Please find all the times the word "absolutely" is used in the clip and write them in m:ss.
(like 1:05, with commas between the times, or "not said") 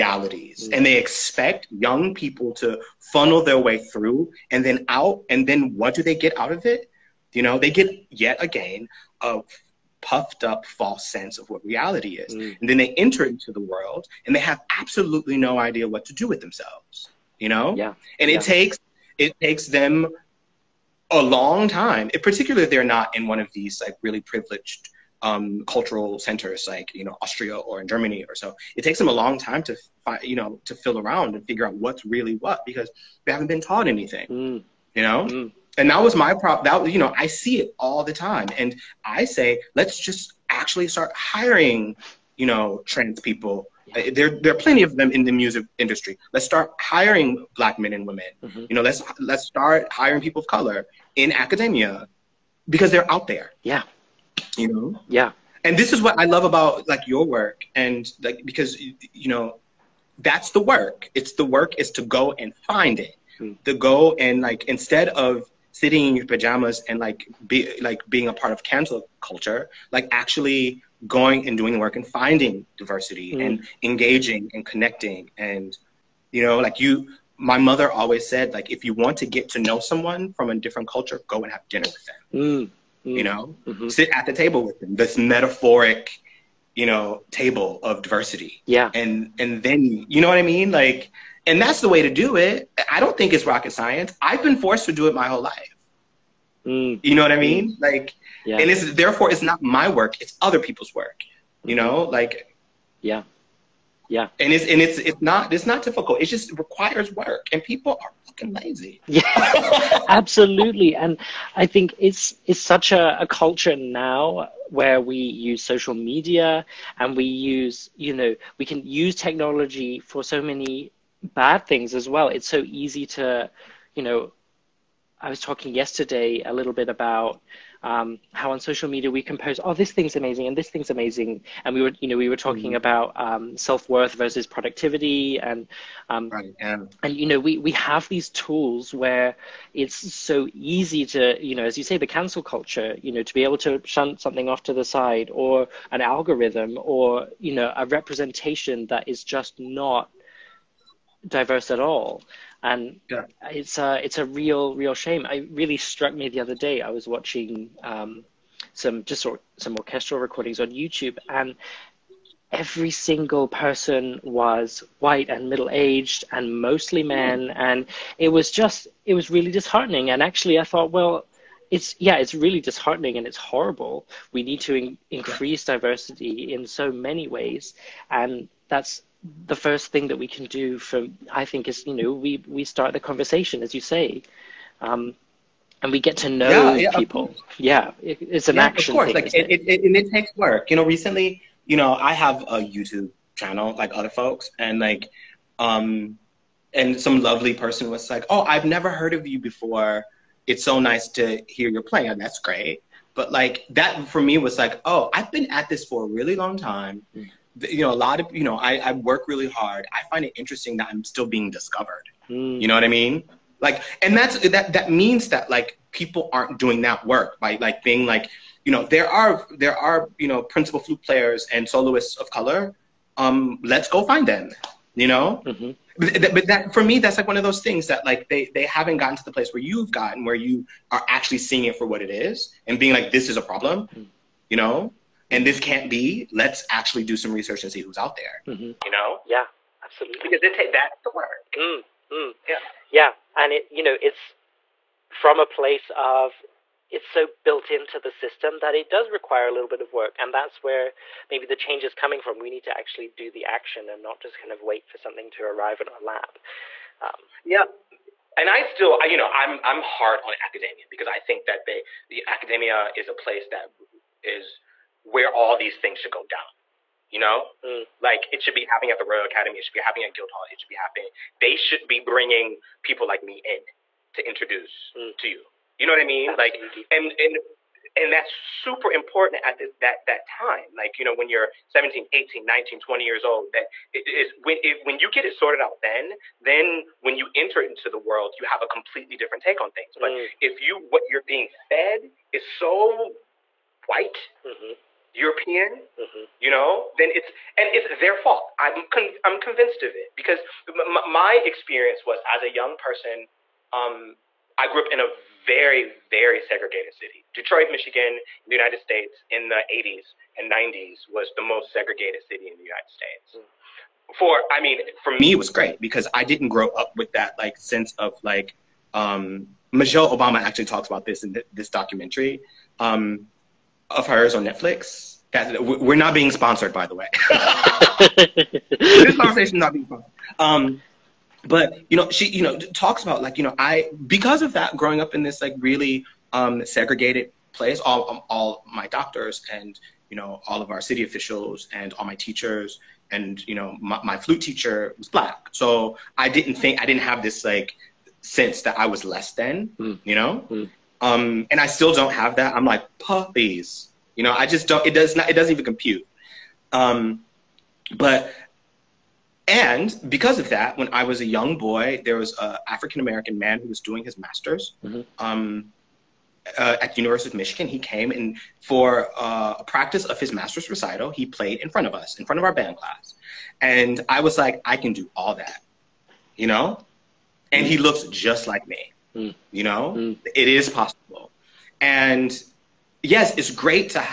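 0:14, 1:50, 3:59, 4:36.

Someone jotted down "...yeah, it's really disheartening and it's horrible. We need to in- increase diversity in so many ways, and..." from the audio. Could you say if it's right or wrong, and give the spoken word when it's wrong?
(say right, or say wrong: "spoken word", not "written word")
right.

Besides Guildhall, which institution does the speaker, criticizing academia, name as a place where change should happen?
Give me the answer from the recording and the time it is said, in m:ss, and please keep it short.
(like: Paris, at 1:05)
Royal Academy, at 4:29.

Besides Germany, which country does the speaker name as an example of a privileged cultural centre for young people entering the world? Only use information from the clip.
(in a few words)
Austria.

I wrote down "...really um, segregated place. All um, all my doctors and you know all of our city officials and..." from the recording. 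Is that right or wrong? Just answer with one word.
right.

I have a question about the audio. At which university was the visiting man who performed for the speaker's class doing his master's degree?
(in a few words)
University of Michigan.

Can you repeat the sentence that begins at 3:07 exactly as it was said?
Yeah, it, it's an yeah, action.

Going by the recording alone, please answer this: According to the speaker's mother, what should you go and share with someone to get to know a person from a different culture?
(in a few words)
Dinner.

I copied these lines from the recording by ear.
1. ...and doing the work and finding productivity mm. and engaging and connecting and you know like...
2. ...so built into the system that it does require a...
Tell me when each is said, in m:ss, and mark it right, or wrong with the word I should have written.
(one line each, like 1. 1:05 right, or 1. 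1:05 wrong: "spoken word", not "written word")
1. 1:11 wrong: "diversity", not "productivity"
2. 4:07 right.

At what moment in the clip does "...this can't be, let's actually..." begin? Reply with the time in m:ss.
3:55.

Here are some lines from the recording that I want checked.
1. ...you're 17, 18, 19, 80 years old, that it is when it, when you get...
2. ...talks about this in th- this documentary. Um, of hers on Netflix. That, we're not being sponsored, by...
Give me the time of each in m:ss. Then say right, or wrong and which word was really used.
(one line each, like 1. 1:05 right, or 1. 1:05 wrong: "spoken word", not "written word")
1. 4:41 wrong: "20", not "80"
2. 5:20 right.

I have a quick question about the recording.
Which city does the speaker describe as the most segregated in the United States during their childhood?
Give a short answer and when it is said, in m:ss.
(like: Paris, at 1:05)
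Detroit, at 5:07.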